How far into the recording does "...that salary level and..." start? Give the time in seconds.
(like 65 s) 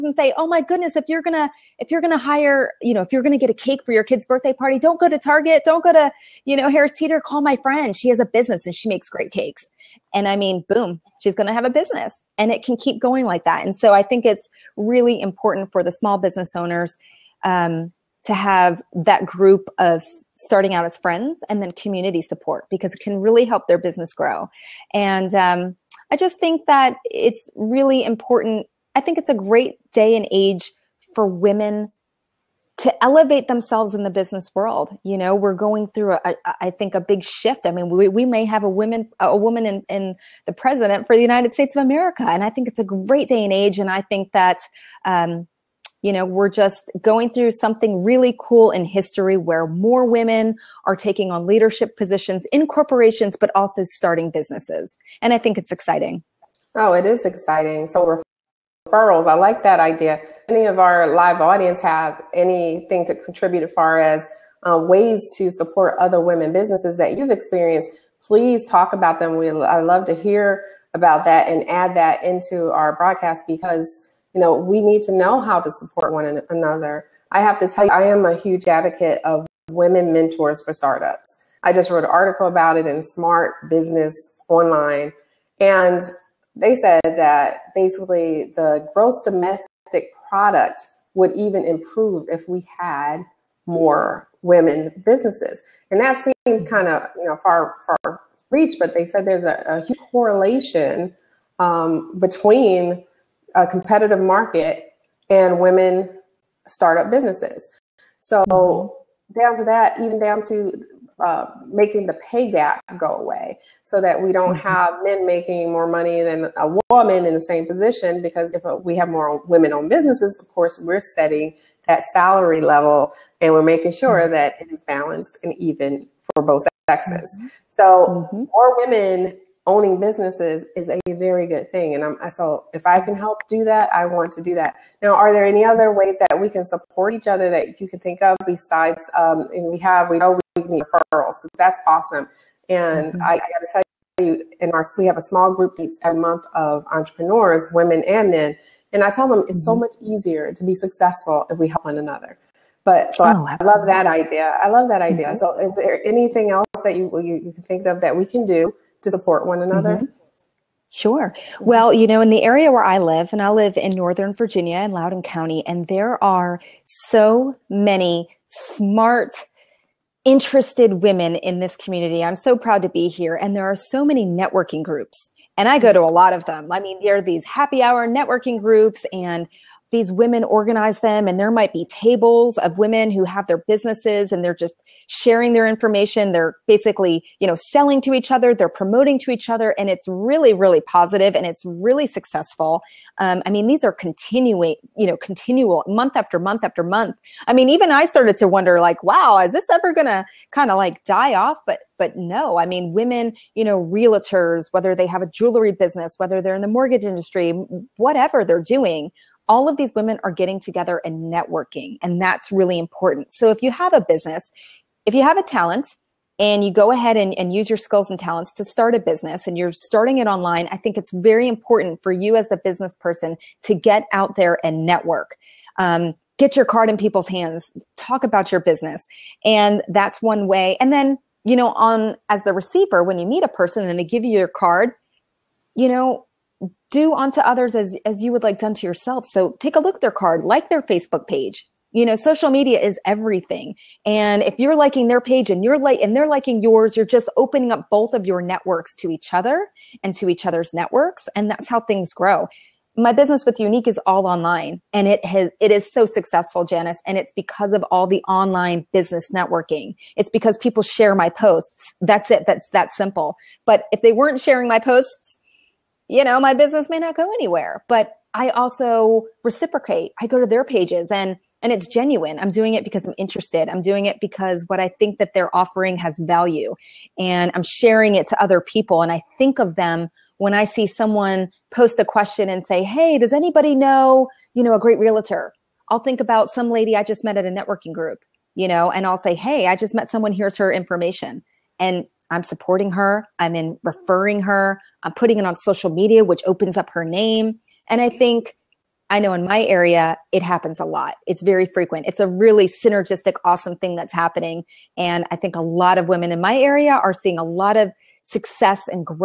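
121 s.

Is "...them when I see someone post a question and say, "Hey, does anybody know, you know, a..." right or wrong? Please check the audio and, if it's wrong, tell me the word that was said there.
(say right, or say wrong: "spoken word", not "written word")
right.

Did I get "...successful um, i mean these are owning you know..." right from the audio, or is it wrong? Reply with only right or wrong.
wrong.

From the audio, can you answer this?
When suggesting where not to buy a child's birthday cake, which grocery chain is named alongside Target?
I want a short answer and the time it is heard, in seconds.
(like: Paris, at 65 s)
Harris Teeter, at 6 s.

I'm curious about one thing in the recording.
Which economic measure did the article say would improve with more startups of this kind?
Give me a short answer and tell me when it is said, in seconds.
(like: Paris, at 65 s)
gross domestic product, at 88 s.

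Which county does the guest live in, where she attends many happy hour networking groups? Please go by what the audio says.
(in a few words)
Loudoun County.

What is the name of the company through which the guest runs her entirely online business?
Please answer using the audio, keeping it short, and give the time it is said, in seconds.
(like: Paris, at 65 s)
Younique, at 253 s.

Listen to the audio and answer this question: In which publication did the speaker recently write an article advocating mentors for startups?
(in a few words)
Smart Business Online.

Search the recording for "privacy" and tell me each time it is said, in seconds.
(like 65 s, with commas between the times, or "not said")
not said.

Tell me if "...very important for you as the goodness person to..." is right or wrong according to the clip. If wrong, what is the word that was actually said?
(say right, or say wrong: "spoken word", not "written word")
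wrong: "business", not "goodness".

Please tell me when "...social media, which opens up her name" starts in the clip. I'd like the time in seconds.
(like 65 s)
295 s.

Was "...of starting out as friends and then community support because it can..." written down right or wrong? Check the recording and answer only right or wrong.
right.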